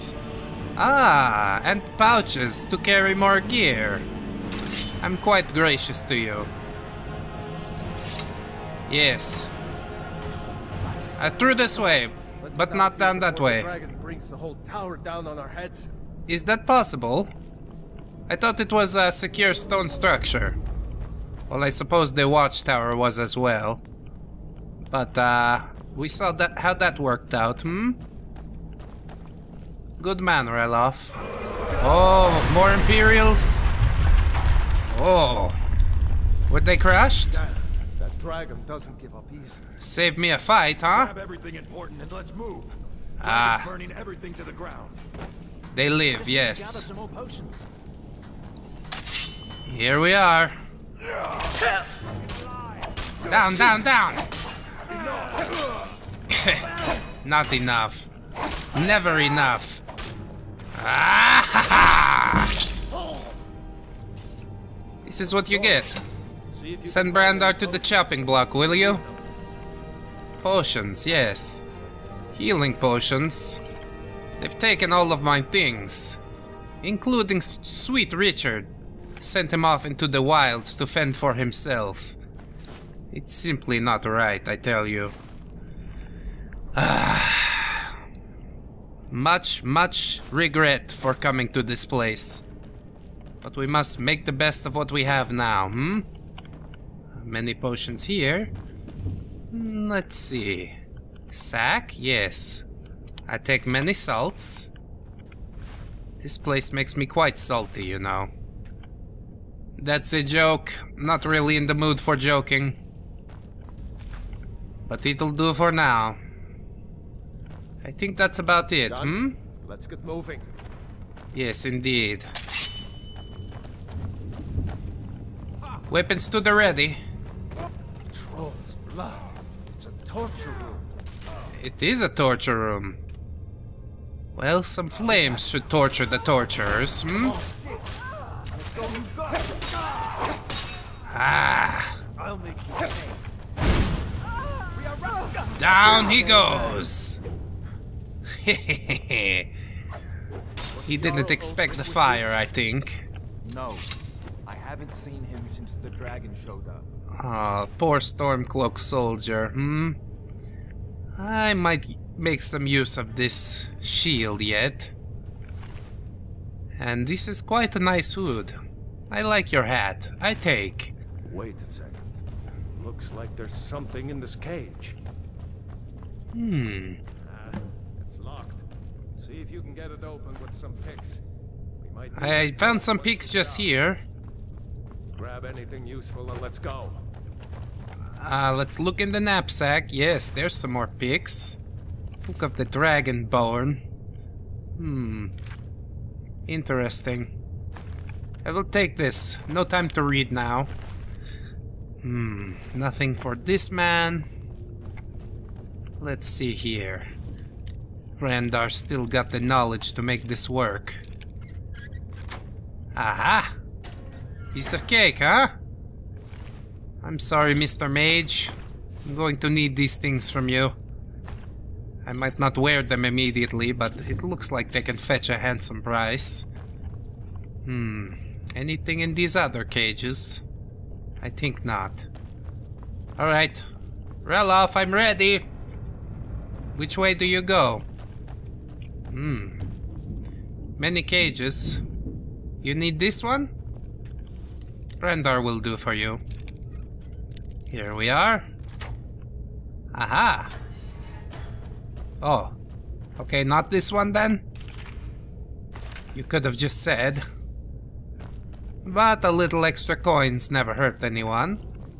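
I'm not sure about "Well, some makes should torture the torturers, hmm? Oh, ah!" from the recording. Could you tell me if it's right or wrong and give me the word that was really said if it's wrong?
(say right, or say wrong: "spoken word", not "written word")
wrong: "flames", not "makes".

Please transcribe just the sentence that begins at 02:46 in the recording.
And this is quite a nice hood.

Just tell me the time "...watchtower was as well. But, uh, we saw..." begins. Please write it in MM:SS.
00:22.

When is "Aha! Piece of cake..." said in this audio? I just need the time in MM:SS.
03:32.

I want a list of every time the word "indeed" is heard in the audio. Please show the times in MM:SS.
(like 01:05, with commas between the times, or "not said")
02:01.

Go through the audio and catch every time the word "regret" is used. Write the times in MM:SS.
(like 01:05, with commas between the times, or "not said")
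01:30.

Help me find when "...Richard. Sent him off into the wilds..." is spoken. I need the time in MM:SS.
01:18.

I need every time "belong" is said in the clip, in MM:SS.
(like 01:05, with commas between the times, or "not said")
not said.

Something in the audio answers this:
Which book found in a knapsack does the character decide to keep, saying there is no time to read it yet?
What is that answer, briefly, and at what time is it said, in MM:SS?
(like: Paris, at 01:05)
Book of the Dragonborn, at 03:12.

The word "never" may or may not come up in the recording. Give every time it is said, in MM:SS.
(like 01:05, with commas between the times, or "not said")
00:58, 04:20.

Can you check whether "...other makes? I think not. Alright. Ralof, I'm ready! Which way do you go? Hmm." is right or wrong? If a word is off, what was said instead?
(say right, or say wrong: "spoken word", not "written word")
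wrong: "cages", not "makes".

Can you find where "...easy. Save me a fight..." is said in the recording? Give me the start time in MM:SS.
00:39.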